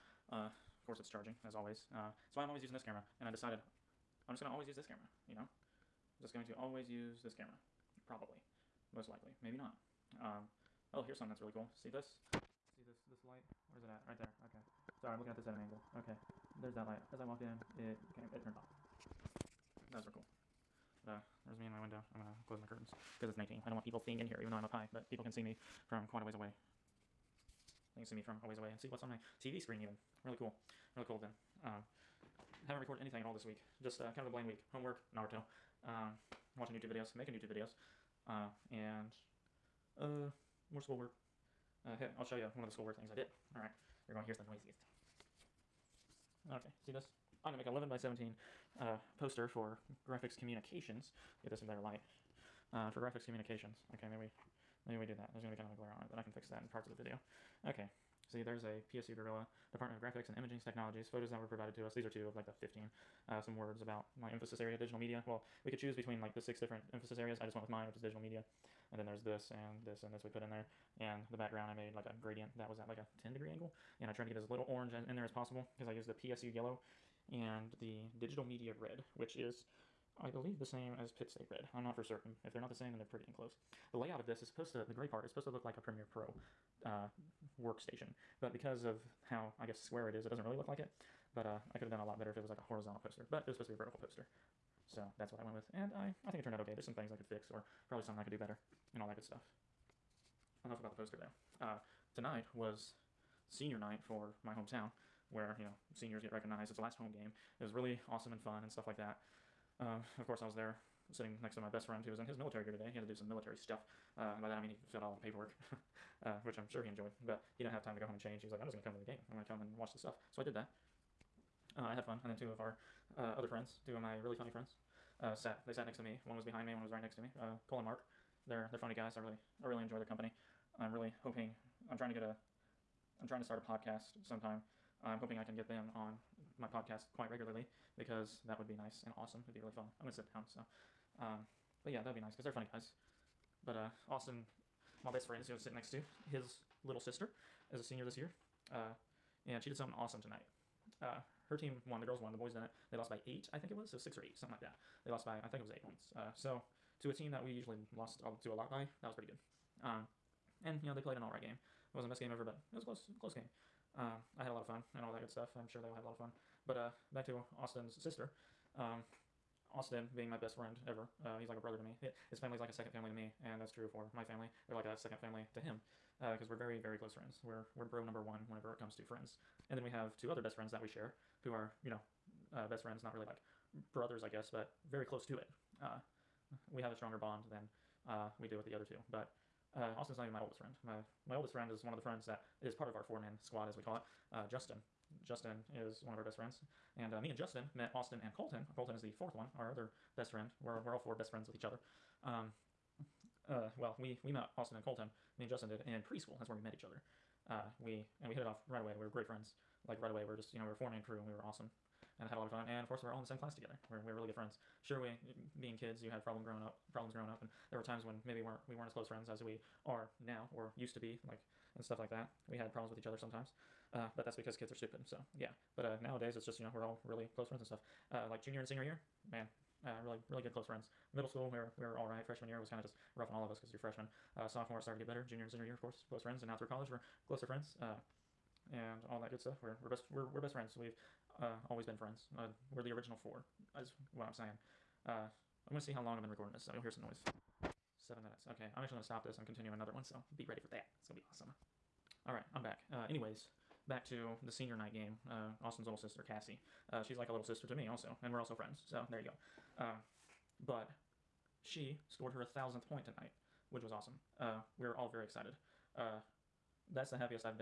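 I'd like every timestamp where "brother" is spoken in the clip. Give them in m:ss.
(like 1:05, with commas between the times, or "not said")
2:51, 3:03.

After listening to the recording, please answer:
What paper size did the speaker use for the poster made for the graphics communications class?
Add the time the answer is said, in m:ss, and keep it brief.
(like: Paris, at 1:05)
11 by 17, at 0:47.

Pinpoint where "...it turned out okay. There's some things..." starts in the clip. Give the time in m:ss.
1:36.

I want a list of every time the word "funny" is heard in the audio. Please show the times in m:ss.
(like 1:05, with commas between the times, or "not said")
2:04, 2:08, 2:22.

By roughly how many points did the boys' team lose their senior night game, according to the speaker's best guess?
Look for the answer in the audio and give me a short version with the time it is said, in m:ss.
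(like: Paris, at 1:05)
8, at 2:35.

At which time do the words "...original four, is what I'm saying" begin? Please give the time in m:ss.
4:02.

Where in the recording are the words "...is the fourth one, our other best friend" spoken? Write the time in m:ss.
3:18.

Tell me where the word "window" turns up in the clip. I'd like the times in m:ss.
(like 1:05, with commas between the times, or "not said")
0:21.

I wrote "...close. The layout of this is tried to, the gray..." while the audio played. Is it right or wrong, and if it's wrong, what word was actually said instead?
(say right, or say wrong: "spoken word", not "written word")
wrong: "supposed", not "tried".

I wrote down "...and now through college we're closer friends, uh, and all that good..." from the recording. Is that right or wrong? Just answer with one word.
right.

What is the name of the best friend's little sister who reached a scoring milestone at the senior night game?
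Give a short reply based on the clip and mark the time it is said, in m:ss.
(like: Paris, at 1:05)
Cassie, at 4:16.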